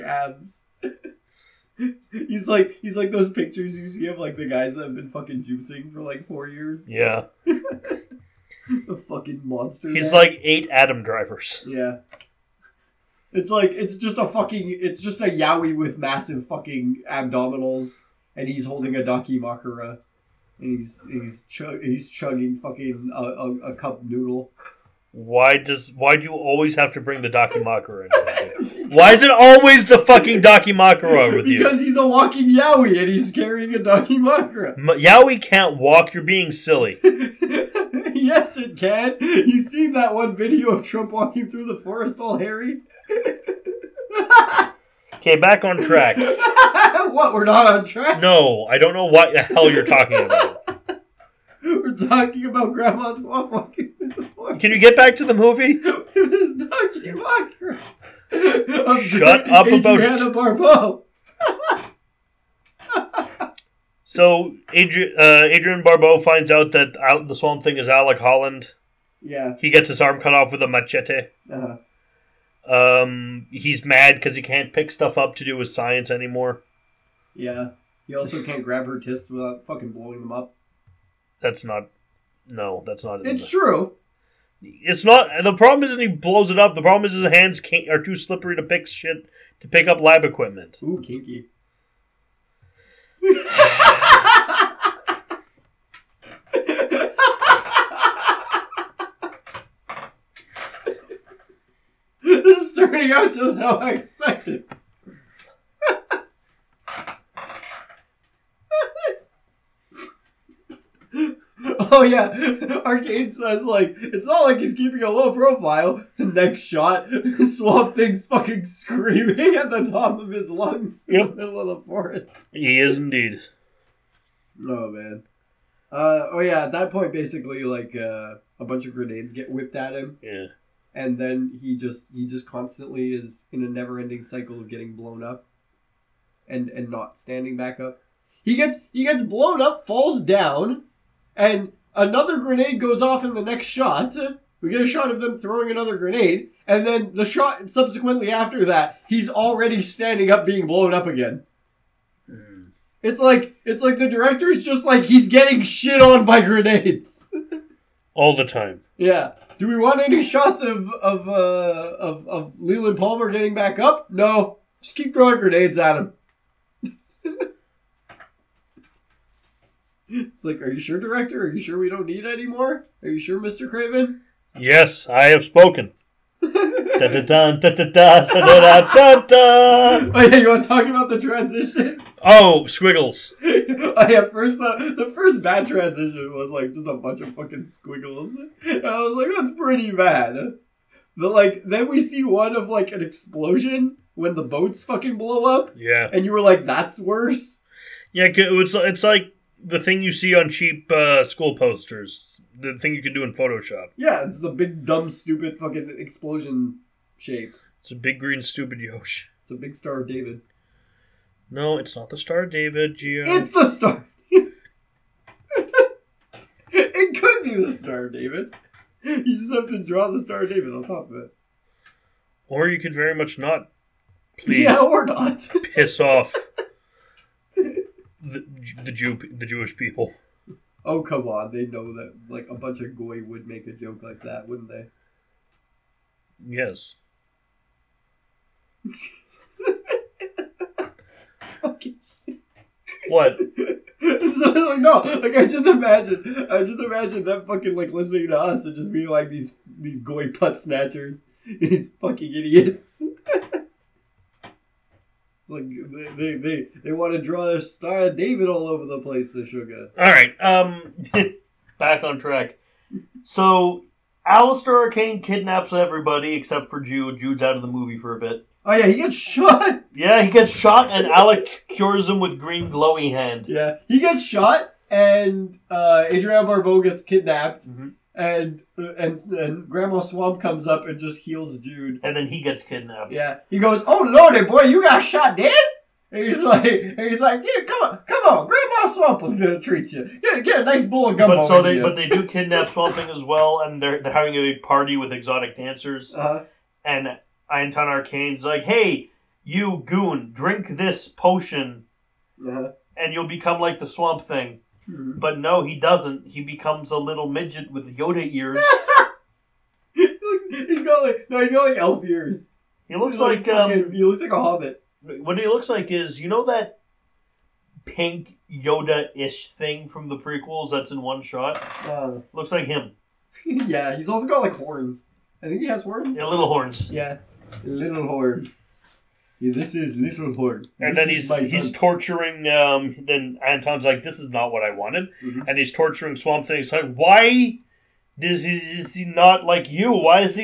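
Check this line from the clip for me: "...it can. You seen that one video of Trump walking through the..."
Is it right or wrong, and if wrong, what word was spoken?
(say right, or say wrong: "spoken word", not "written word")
right.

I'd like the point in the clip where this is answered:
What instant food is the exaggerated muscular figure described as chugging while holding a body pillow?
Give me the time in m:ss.
0:23.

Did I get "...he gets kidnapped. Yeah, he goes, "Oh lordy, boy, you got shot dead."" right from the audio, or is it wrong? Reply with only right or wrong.
right.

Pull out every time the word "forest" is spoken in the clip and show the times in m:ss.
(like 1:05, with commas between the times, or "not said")
0:41, 0:54, 2:01.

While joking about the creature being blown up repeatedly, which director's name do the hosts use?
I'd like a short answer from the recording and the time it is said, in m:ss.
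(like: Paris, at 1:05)
Craven, at 2:53.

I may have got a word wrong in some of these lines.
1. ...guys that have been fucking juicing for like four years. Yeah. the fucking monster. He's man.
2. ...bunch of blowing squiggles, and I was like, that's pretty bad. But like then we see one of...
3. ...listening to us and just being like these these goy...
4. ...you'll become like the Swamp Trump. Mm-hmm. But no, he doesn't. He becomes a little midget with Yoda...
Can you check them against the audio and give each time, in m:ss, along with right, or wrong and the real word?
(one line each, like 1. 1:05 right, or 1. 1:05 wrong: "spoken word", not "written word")
1. 0:04 right
2. 3:06 wrong: "fucking", not "blowing"
3. 4:07 right
4. 5:03 wrong: "Thing", not "Trump".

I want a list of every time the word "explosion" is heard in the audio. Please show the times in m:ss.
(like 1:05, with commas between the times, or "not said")
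3:13, 3:25.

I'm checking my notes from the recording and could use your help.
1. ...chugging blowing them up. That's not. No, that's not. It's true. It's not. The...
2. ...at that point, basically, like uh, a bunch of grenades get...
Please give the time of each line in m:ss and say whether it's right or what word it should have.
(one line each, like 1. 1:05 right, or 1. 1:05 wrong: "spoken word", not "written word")
1. 1:19 wrong: "fucking", not "chugging"
2. 2:06 right.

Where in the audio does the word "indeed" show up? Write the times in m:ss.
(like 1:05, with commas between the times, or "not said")
2:02.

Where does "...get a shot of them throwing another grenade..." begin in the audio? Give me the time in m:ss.
2:24.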